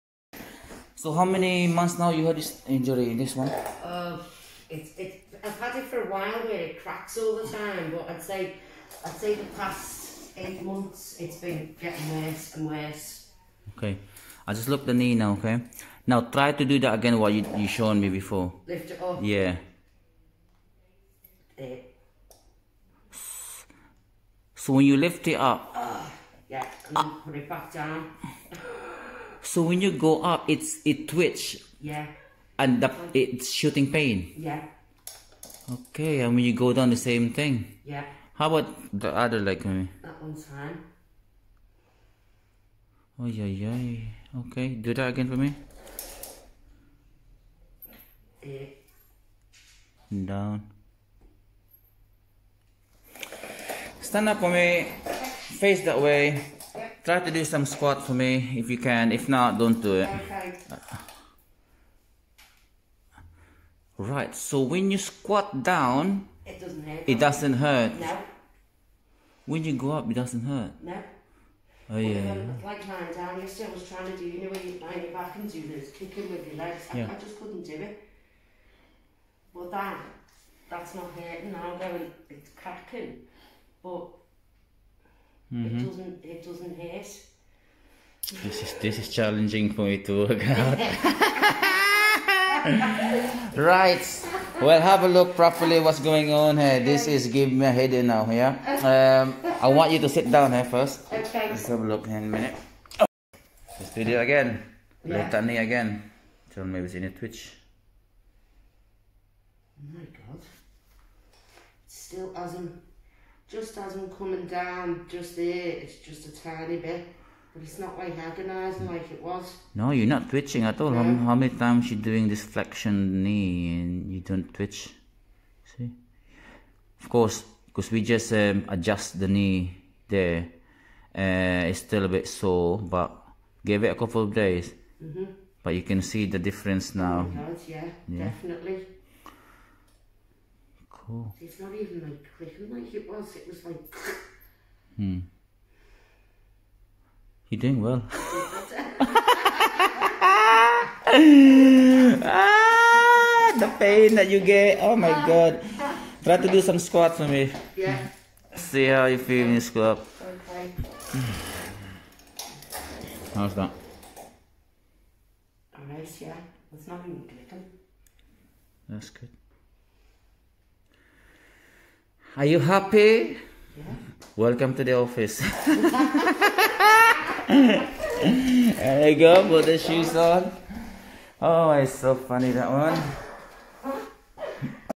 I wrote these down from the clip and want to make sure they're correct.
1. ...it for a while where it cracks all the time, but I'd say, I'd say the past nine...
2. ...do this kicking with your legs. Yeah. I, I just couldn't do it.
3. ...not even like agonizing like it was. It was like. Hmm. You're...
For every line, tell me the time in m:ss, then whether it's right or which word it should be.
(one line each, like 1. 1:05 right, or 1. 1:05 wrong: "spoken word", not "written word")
1. 0:05 wrong: "eight", not "nine"
2. 1:15 right
3. 2:21 wrong: "clicking", not "agonizing".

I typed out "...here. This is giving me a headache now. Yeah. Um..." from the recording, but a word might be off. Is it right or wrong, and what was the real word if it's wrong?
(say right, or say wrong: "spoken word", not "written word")
right.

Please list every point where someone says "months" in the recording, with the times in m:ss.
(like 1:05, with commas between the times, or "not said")
0:01, 0:10.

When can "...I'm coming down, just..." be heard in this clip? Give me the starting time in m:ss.
1:53.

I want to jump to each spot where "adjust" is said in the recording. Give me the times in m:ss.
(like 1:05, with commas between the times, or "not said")
2:08.